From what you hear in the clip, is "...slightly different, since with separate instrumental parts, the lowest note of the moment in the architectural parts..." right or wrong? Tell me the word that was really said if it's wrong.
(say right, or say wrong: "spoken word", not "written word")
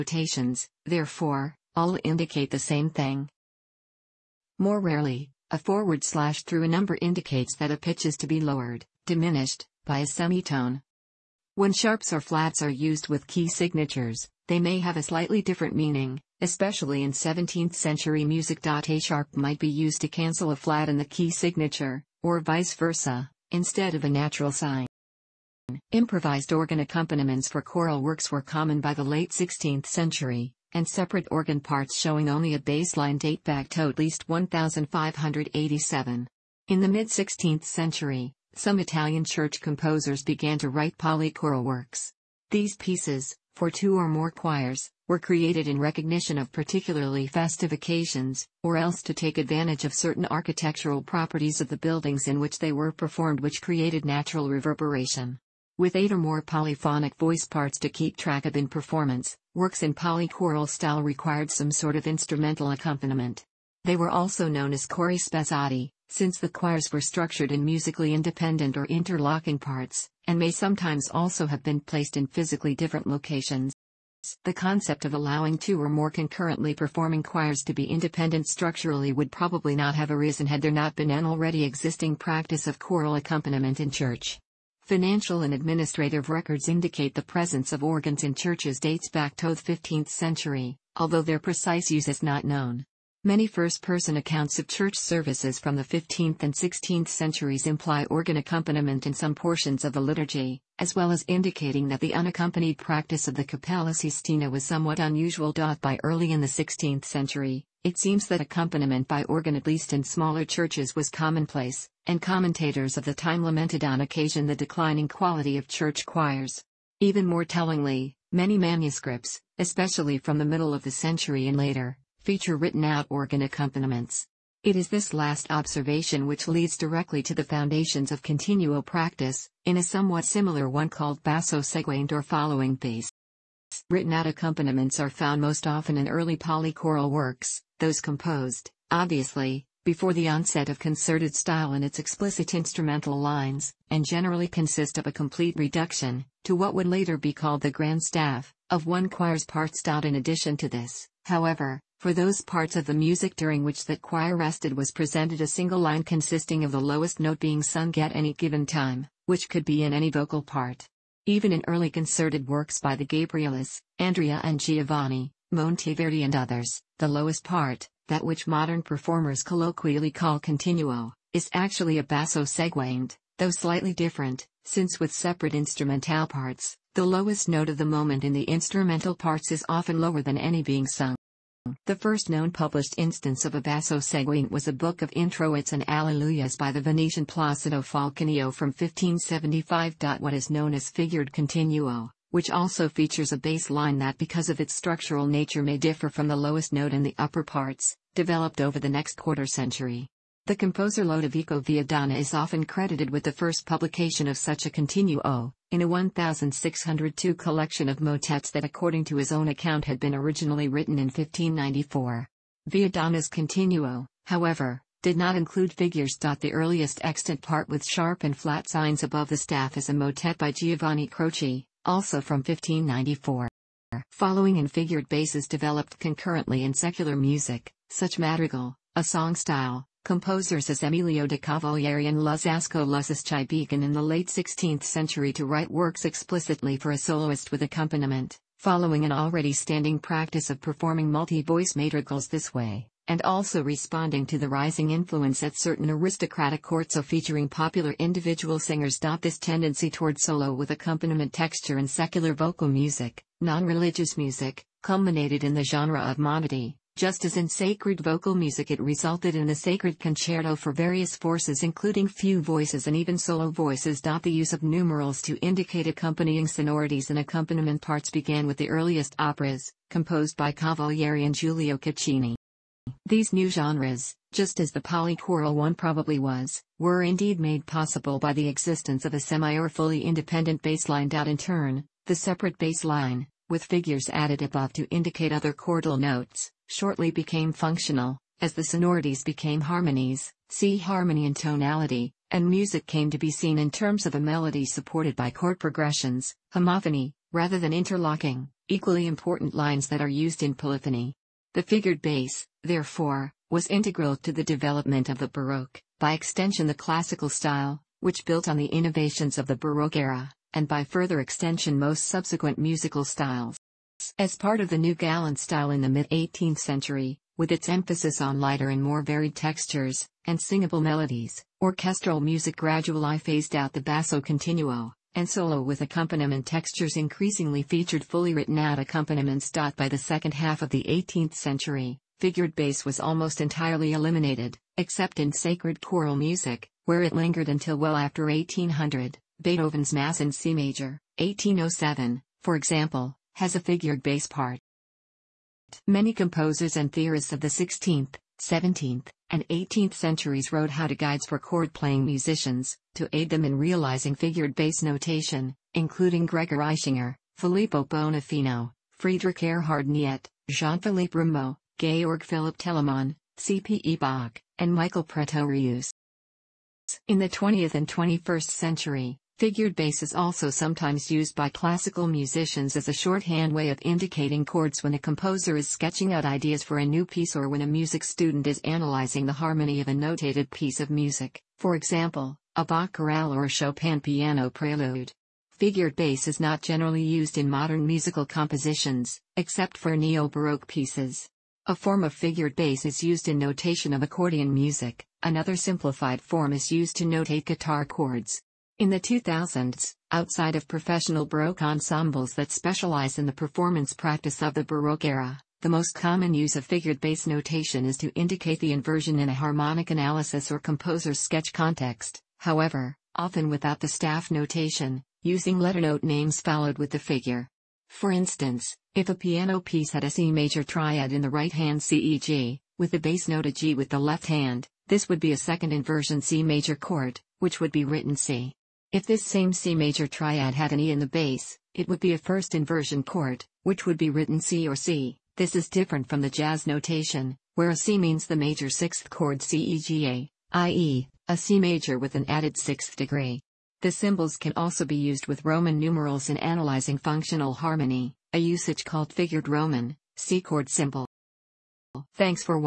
wrong: "instrumental", not "architectural".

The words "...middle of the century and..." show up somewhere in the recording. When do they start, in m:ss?
2:00.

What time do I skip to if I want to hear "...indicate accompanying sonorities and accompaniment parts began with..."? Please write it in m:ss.
4:25.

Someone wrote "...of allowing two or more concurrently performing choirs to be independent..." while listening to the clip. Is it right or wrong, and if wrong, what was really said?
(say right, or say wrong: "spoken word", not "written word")
right.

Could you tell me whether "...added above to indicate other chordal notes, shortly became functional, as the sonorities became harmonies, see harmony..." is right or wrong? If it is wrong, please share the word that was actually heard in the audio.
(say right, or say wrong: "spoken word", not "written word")
right.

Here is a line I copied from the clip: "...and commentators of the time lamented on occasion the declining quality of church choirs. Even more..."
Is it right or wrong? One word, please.
right.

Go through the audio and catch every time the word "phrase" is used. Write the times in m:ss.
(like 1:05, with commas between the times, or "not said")
not said.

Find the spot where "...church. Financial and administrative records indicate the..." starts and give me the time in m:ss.
1:23.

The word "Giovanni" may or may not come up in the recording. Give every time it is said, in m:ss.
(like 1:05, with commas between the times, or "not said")
2:44, 3:40.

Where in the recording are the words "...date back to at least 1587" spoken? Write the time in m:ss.
0:33.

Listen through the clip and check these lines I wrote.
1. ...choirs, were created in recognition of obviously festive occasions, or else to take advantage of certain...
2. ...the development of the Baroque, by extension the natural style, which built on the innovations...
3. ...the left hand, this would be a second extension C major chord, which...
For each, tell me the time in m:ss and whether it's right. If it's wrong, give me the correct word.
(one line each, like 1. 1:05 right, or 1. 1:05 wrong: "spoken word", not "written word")
1. 0:44 wrong: "particularly", not "obviously"
2. 5:04 wrong: "classical", not "natural"
3. 7:03 wrong: "inversion", not "extension".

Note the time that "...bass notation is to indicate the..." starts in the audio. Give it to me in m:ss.
6:46.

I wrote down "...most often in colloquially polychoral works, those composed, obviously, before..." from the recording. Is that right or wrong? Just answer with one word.
wrong.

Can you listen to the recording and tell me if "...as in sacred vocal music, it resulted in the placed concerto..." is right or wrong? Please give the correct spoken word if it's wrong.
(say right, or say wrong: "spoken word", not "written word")
wrong: "sacred", not "placed".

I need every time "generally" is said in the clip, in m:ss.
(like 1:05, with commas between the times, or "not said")
2:24, 6:26.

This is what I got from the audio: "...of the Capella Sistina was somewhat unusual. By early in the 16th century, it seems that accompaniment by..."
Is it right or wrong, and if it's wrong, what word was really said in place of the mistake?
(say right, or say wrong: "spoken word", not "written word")
right.